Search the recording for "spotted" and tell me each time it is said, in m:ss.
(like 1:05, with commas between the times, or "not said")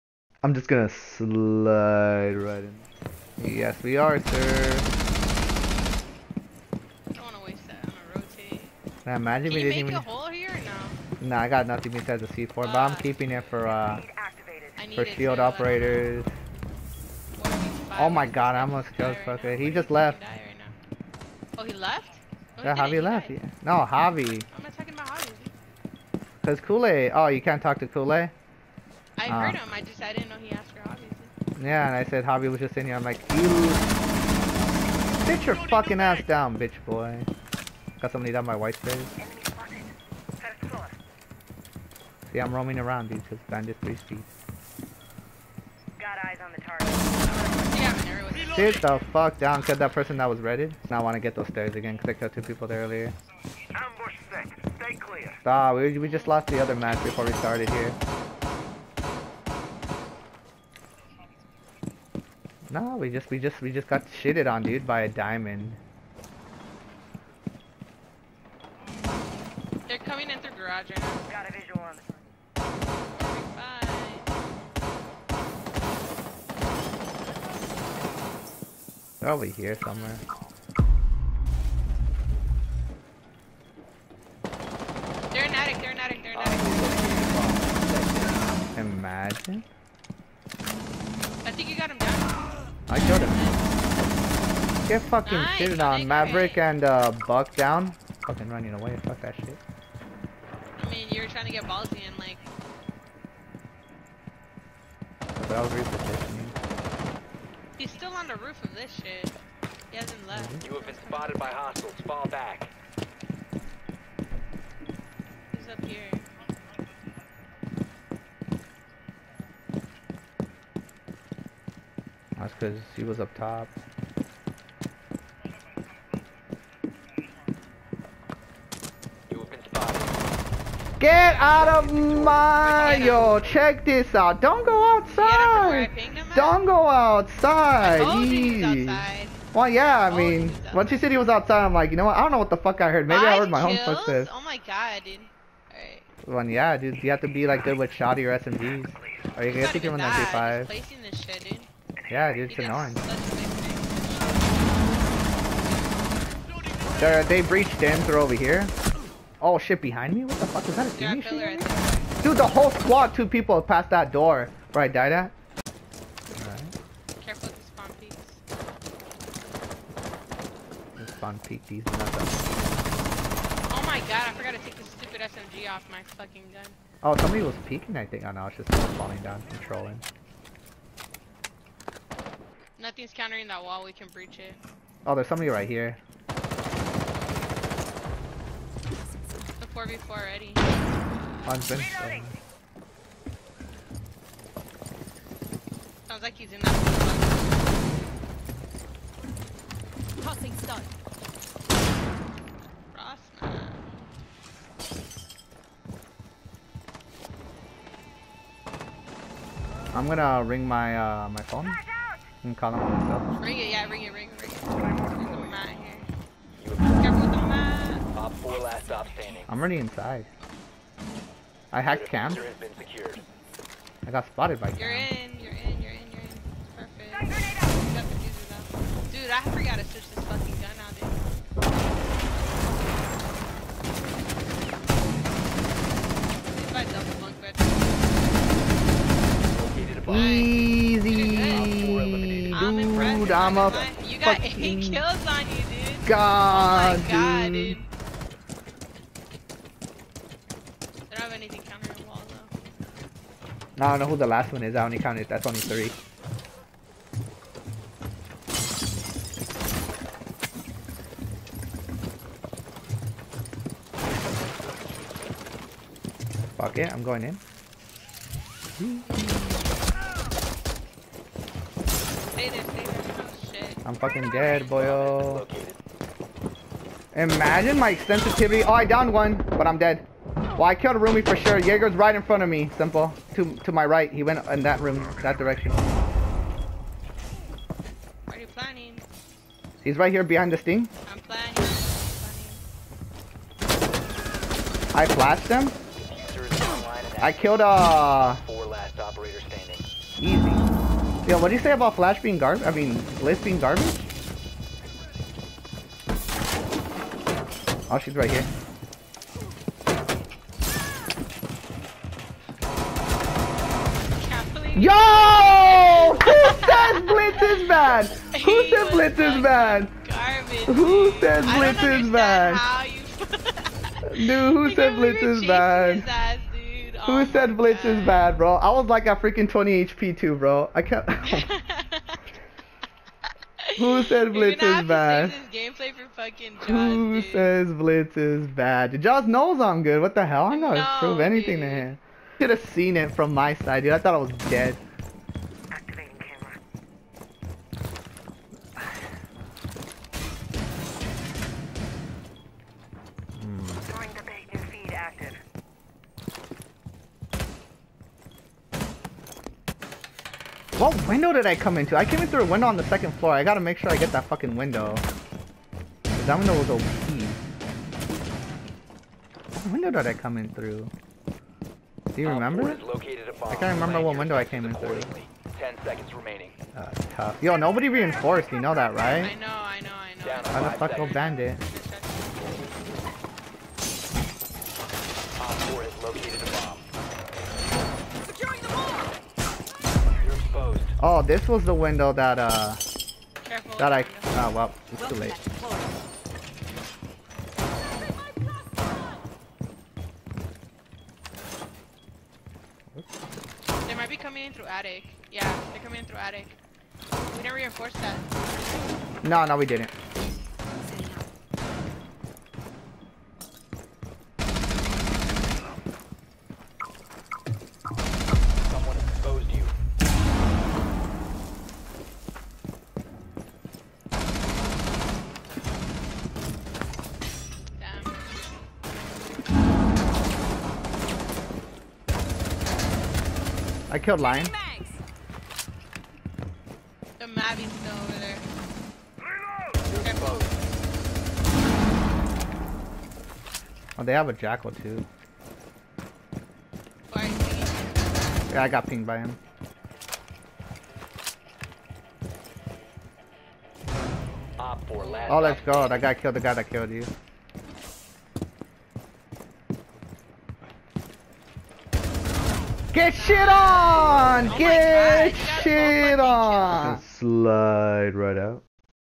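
1:51, 3:44.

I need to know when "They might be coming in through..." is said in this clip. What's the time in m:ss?
6:43.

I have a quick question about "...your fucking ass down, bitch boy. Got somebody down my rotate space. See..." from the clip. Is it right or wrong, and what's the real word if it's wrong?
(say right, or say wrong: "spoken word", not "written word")
wrong: "white", not "rotate".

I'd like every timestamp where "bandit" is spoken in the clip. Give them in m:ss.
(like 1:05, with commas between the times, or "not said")
0:43, 6:21.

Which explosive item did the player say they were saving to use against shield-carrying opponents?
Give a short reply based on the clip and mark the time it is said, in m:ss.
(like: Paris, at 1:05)
C4, at 0:12.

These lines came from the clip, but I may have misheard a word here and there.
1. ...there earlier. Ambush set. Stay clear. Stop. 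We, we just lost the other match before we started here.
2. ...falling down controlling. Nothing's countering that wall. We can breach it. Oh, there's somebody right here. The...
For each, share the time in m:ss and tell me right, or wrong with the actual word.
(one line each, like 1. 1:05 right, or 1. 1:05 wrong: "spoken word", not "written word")
1. 0:52 right
2. 2:58 right.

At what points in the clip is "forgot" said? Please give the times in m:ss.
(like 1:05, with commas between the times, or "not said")
2:54, 3:49.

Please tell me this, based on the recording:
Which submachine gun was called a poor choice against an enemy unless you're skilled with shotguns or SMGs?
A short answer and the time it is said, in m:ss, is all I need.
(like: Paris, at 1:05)
MP5, at 2:30.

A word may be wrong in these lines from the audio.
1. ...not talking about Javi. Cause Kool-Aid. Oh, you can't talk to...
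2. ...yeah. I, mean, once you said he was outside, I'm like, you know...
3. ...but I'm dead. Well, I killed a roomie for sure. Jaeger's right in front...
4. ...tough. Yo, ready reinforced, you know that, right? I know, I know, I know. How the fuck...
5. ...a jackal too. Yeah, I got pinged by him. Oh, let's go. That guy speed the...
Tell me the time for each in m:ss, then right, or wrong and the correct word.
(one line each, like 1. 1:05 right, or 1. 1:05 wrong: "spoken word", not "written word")
1. 0:24 right
2. 2:19 right
3. 4:39 right
4. 6:17 wrong: "nobody", not "ready"
5. 7:24 wrong: "killed", not "speed".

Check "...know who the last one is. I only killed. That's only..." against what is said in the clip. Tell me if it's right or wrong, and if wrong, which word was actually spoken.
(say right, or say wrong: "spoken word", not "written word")
wrong: "counted", not "killed".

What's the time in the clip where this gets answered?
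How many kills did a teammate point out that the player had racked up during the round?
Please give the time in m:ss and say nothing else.
4:04.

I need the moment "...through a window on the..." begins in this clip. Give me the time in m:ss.
6:02.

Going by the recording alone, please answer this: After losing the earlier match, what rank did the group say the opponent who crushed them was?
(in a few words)
Diamond.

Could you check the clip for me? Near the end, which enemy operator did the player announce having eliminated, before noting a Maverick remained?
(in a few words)
Lion.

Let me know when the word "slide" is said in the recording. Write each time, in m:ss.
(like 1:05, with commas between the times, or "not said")
0:00, 7:47.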